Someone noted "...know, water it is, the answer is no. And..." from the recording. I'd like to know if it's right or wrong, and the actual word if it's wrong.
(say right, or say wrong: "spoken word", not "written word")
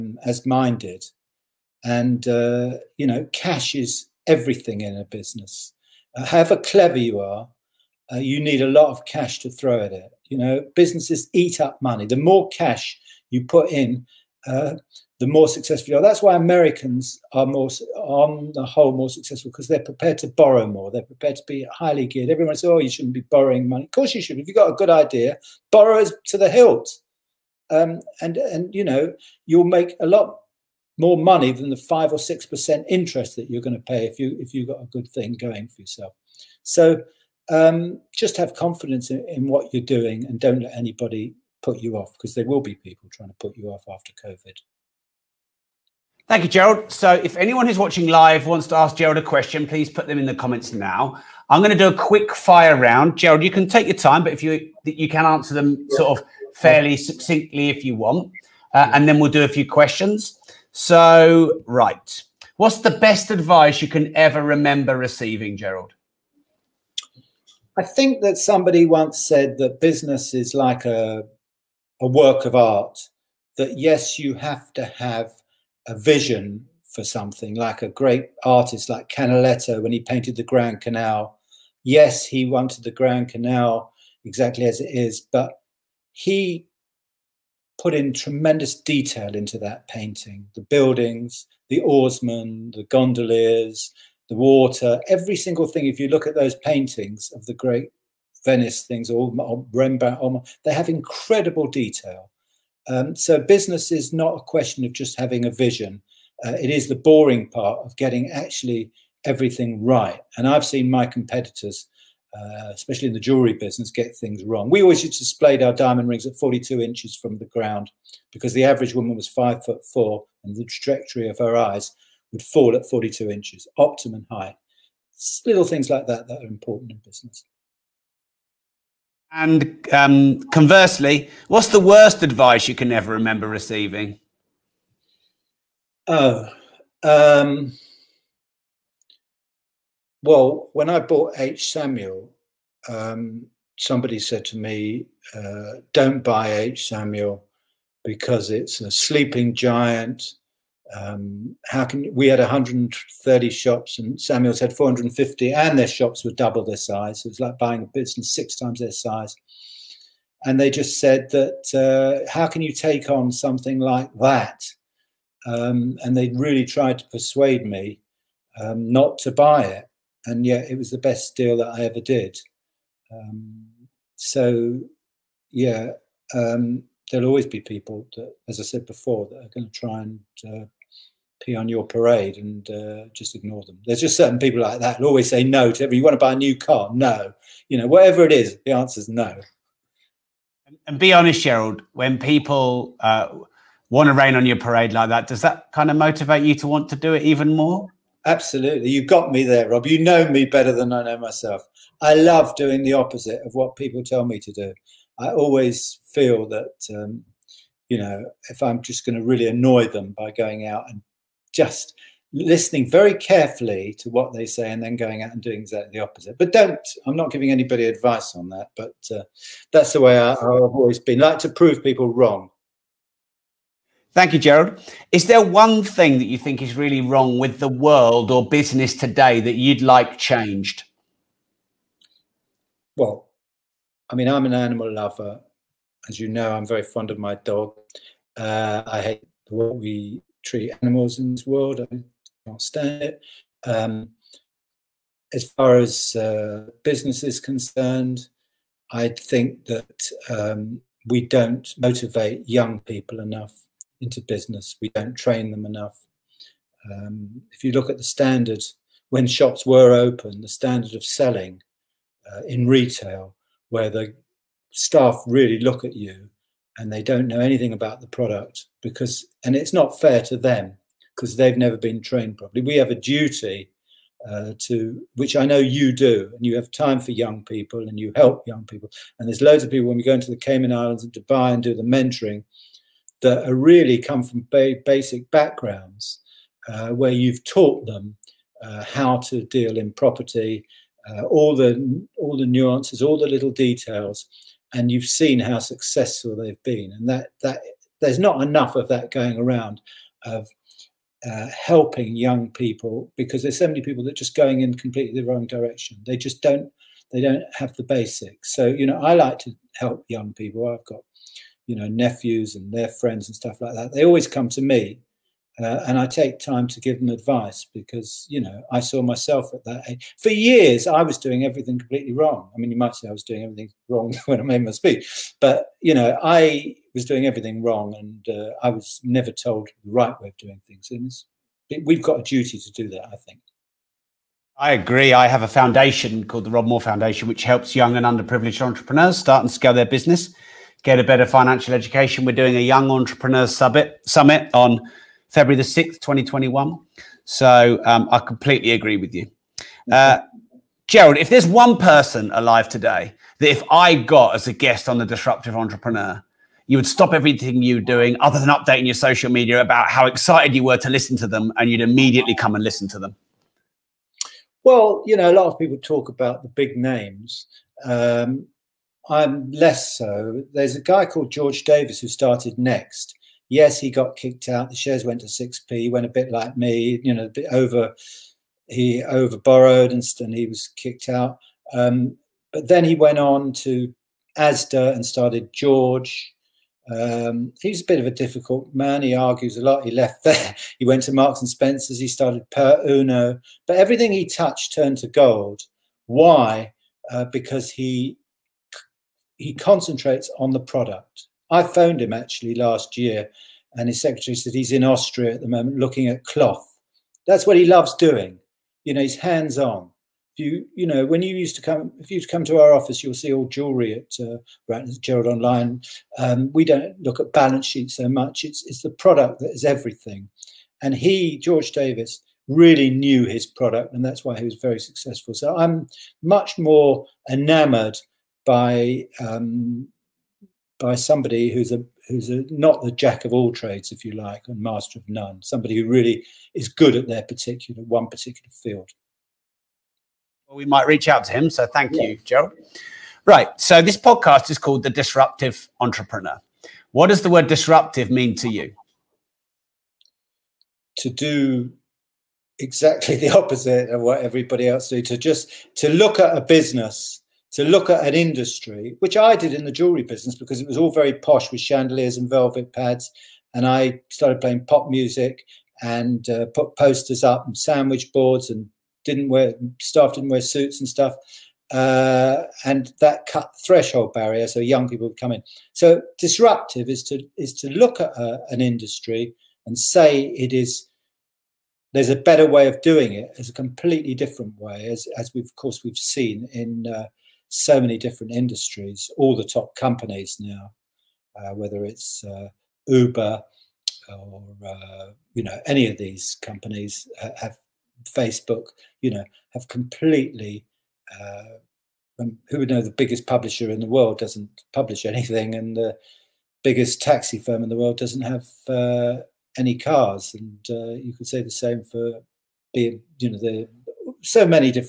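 wrong: "whatever", not "water".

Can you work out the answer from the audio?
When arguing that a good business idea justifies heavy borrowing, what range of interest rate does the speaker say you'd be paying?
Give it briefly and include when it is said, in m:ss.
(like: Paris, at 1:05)
5 or 6 percent, at 0:31.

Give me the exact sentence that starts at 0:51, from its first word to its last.
I'm going to do a quick fire round.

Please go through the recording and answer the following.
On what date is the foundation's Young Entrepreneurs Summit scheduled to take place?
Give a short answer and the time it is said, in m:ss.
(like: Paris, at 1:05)
6 February 2021, at 5:45.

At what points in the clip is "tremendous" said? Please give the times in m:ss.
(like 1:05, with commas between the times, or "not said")
1:28.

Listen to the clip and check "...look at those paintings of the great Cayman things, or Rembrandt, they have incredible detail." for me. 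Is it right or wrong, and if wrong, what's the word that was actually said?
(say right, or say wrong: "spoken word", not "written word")
wrong: "Venice", not "Cayman".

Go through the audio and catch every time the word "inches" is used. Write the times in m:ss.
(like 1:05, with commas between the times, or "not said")
1:56, 2:03.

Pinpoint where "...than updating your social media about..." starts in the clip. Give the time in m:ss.
5:58.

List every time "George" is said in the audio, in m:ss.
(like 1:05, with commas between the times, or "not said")
6:11, 6:25, 7:01.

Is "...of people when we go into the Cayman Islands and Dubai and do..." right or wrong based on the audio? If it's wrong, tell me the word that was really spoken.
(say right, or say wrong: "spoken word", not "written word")
right.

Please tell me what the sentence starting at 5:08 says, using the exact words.
So you know, I like to help young people.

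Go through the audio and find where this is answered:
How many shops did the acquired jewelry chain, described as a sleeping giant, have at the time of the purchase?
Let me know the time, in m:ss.
2:34.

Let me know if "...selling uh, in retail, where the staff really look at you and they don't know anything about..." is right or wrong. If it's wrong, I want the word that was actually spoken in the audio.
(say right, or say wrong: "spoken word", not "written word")
right.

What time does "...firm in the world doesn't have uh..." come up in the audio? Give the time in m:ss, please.
8:27.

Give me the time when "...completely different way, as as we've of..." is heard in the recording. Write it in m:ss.
8:03.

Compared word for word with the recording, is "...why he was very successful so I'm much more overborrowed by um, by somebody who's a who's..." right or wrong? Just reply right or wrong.
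wrong.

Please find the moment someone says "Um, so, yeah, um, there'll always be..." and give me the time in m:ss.
2:53.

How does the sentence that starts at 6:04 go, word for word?
Well, you know, a lot of people talk about the big names.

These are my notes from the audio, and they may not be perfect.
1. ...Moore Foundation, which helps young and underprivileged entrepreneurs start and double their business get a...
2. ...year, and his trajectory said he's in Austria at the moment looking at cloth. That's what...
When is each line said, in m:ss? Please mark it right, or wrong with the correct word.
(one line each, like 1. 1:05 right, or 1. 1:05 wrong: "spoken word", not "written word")
1. 5:36 wrong: "scale", not "double"
2. 6:42 wrong: "secretary", not "trajectory".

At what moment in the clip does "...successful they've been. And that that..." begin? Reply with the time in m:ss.
4:55.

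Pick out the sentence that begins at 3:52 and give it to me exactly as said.
Well, I mean, I'm an animal lover.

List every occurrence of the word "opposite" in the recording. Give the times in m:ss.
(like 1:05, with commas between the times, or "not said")
3:22, 3:36, 7:33.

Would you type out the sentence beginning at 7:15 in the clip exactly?
Somebody who really is good at their particular one particular field.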